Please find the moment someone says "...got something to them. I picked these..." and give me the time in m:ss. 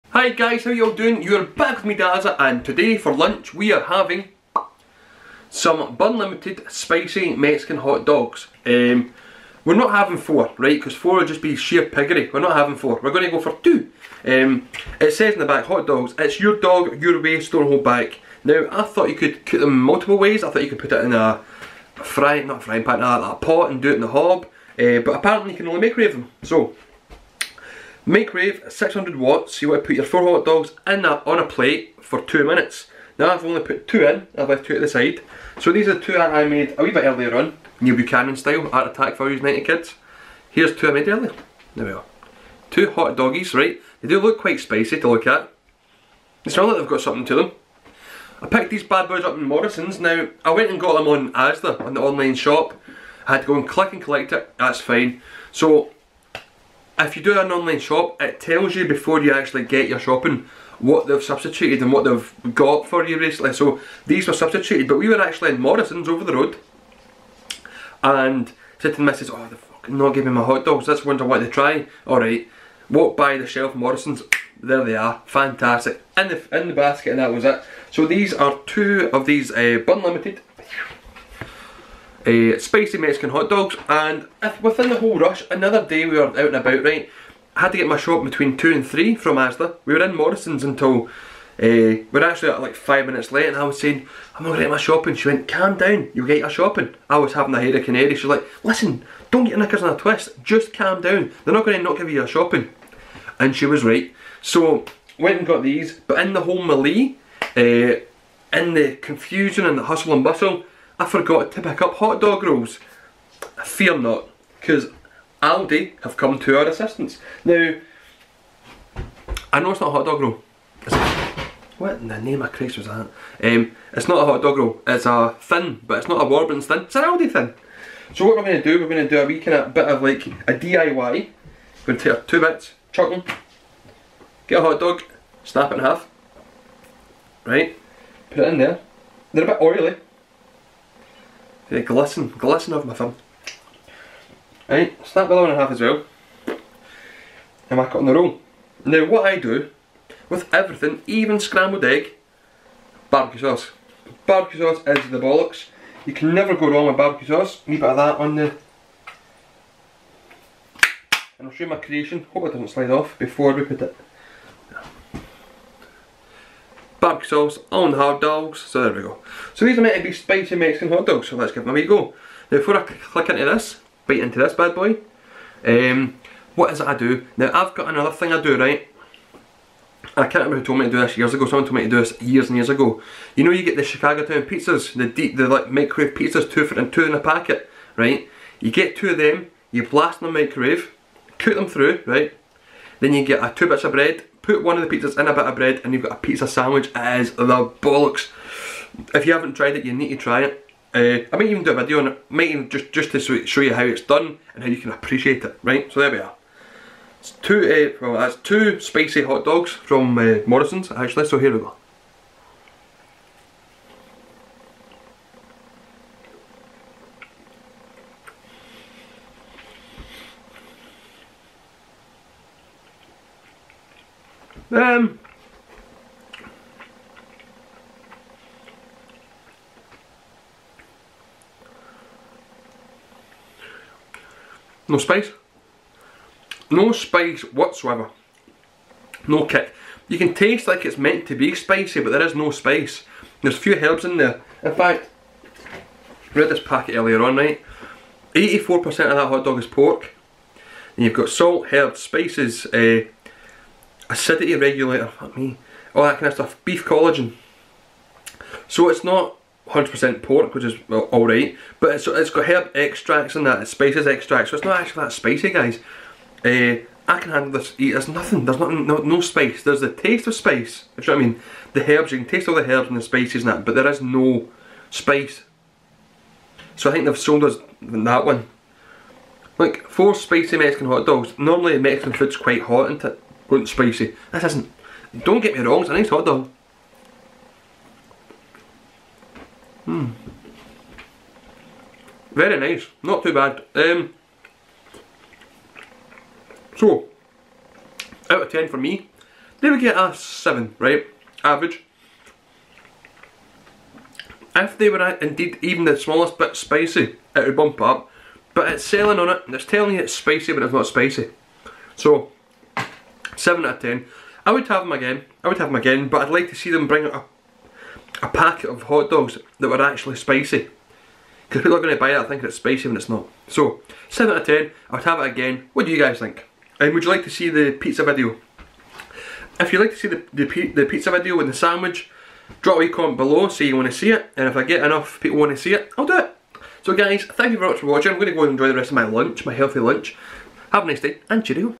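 0:46.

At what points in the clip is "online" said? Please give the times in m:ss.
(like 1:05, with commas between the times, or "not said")
0:52, 0:57.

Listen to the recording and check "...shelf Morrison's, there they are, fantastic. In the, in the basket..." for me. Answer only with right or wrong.
right.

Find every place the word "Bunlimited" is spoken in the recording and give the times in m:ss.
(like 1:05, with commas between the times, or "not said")
0:05, 1:19.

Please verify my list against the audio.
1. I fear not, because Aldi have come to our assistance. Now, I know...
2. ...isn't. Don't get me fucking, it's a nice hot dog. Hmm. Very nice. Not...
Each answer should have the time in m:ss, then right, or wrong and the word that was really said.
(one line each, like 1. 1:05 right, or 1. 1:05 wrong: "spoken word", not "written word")
1. 1:53 right
2. 4:44 wrong: "wrong", not "fucking".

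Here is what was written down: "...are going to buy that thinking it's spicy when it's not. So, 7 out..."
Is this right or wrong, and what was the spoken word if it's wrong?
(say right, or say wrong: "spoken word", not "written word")
right.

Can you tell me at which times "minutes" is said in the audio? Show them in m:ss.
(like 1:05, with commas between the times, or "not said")
0:32, 1:33.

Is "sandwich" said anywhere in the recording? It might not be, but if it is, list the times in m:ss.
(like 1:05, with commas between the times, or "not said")
3:16, 5:31.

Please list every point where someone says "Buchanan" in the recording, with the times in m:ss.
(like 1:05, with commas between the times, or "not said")
0:37.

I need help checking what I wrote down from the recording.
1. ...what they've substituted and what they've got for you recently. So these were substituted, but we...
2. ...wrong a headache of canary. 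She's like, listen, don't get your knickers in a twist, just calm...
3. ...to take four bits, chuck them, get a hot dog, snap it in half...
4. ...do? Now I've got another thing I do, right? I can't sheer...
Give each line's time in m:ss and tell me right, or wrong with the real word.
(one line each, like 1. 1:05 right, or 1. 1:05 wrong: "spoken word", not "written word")
1. 1:00 right
2. 1:37 wrong: "having", not "wrong"
3. 2:11 wrong: "two", not "four"
4. 2:56 wrong: "remember", not "sheer".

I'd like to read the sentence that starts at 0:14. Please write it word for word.
Um, it says in the back, hot dogs, it's your dog, your way, store hold back.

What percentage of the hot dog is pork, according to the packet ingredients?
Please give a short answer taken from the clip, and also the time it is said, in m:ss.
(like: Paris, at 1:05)
84%, at 4:08.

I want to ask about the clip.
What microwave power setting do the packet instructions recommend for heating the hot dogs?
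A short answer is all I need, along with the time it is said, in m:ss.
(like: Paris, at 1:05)
600 watts, at 0:28.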